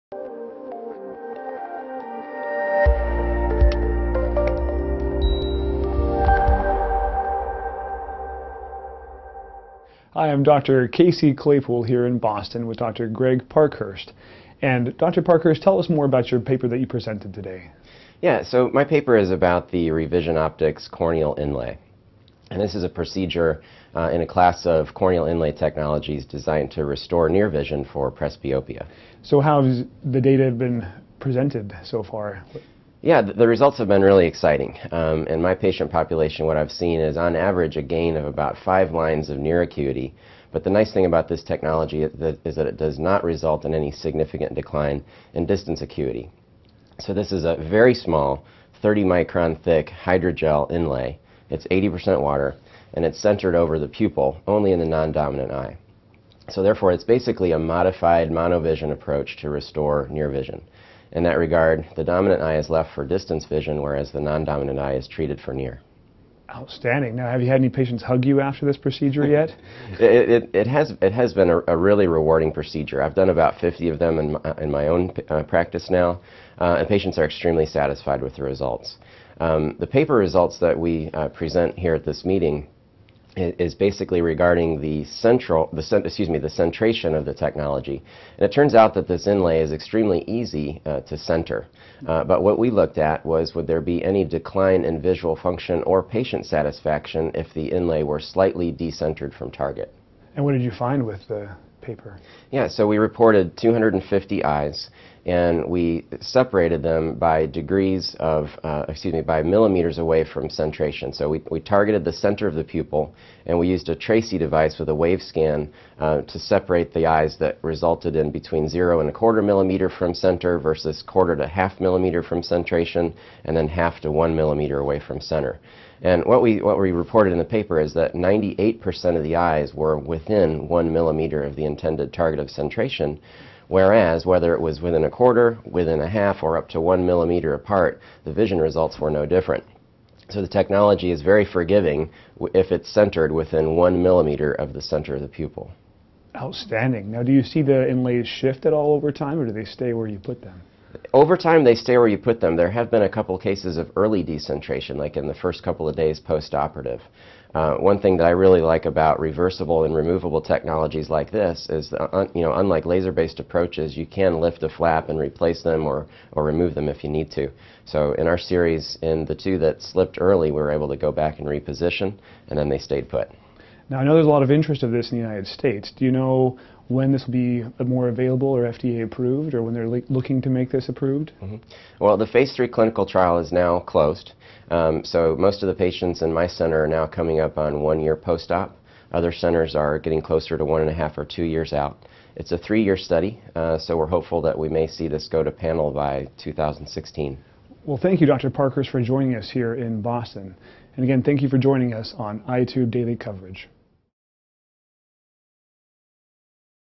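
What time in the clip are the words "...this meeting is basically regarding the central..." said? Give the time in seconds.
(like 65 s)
82 s.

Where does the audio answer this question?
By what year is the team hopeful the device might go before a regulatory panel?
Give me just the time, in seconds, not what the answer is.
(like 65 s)
196 s.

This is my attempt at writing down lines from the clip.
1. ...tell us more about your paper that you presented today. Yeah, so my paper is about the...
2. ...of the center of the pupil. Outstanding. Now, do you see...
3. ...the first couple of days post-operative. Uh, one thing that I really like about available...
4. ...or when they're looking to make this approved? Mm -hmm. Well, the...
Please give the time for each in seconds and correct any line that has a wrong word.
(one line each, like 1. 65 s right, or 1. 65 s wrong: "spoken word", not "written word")
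1. 15 s right
2. 144 s right
3. 155 s wrong: "reversible", not "available"
4. 179 s right.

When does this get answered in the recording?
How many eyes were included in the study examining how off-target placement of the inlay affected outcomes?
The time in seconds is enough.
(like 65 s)
103 s.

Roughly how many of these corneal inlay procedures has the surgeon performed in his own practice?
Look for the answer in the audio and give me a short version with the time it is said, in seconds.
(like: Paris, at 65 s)
50, at 73 s.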